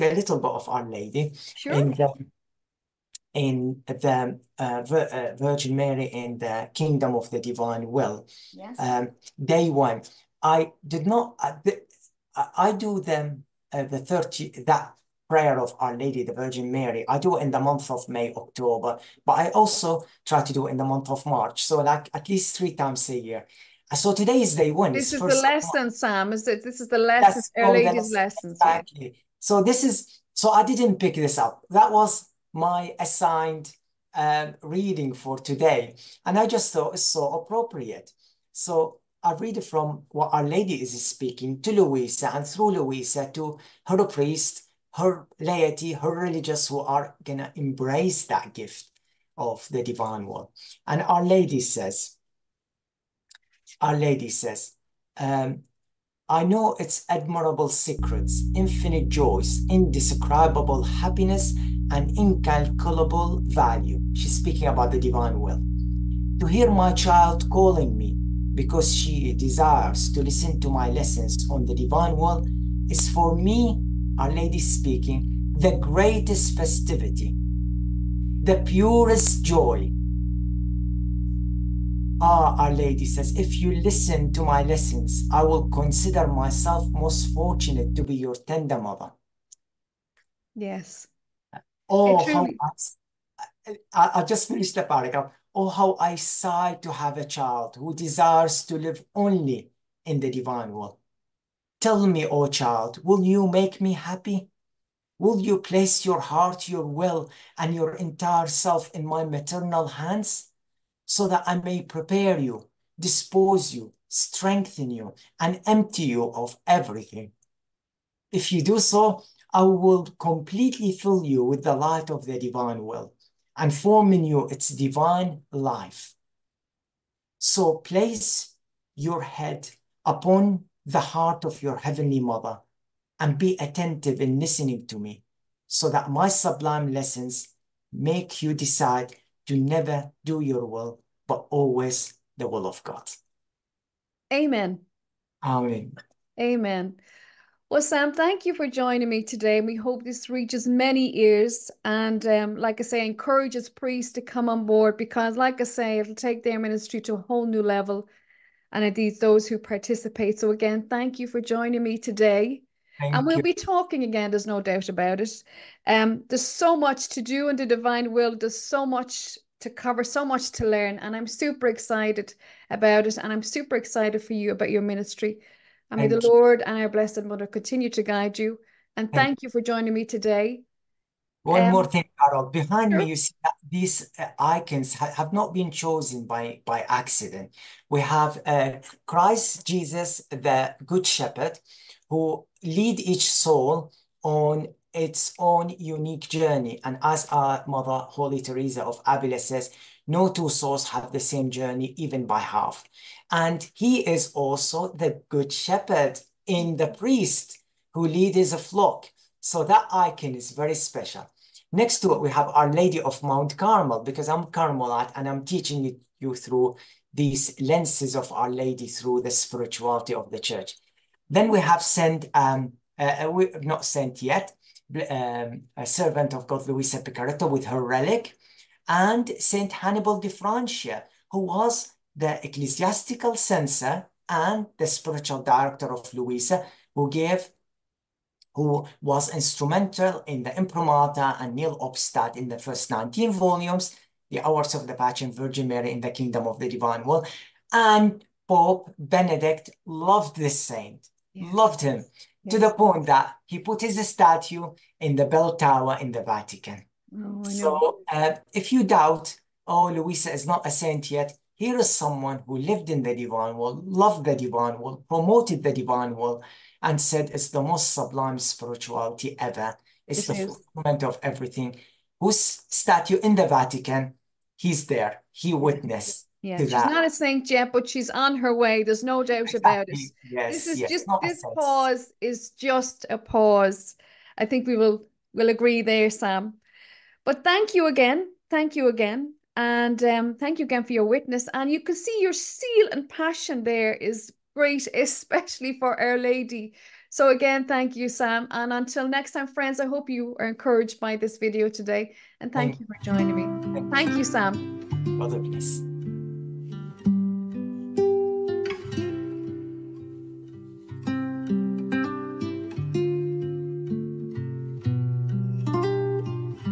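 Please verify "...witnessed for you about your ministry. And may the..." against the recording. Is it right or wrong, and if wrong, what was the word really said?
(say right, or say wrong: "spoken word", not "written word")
wrong: "excited", not "witnessed".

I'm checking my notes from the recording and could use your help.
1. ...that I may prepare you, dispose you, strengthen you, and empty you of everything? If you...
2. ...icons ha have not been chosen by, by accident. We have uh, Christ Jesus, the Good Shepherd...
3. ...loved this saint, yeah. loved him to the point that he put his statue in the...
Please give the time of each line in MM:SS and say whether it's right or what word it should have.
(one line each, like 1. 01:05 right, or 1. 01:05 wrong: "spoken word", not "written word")
1. 01:51 right
2. 03:04 right
3. 04:09 right.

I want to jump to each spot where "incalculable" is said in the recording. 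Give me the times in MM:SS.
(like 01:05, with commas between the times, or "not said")
01:02.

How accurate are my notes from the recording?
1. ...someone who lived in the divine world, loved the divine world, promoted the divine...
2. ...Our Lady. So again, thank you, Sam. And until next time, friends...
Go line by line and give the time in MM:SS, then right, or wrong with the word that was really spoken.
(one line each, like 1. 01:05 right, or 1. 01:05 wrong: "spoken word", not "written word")
1. 04:21 right
2. 04:55 right.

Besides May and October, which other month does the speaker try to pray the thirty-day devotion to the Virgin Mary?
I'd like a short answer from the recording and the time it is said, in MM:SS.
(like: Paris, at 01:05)
March, at 00:21.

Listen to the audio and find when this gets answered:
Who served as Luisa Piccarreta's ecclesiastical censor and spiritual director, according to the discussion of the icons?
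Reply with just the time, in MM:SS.
03:49.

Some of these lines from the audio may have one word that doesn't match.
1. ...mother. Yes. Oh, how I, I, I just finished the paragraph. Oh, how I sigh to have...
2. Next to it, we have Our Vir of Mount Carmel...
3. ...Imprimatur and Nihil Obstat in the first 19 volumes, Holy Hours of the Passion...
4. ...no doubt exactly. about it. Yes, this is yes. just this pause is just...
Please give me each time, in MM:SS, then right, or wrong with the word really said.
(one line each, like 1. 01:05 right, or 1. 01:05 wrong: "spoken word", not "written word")
1. 01:28 right
2. 03:31 wrong: "Lady", not "Vir"
3. 04:00 wrong: "The", not "Holy"
4. 04:39 right.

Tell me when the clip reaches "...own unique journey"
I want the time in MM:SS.
03:15.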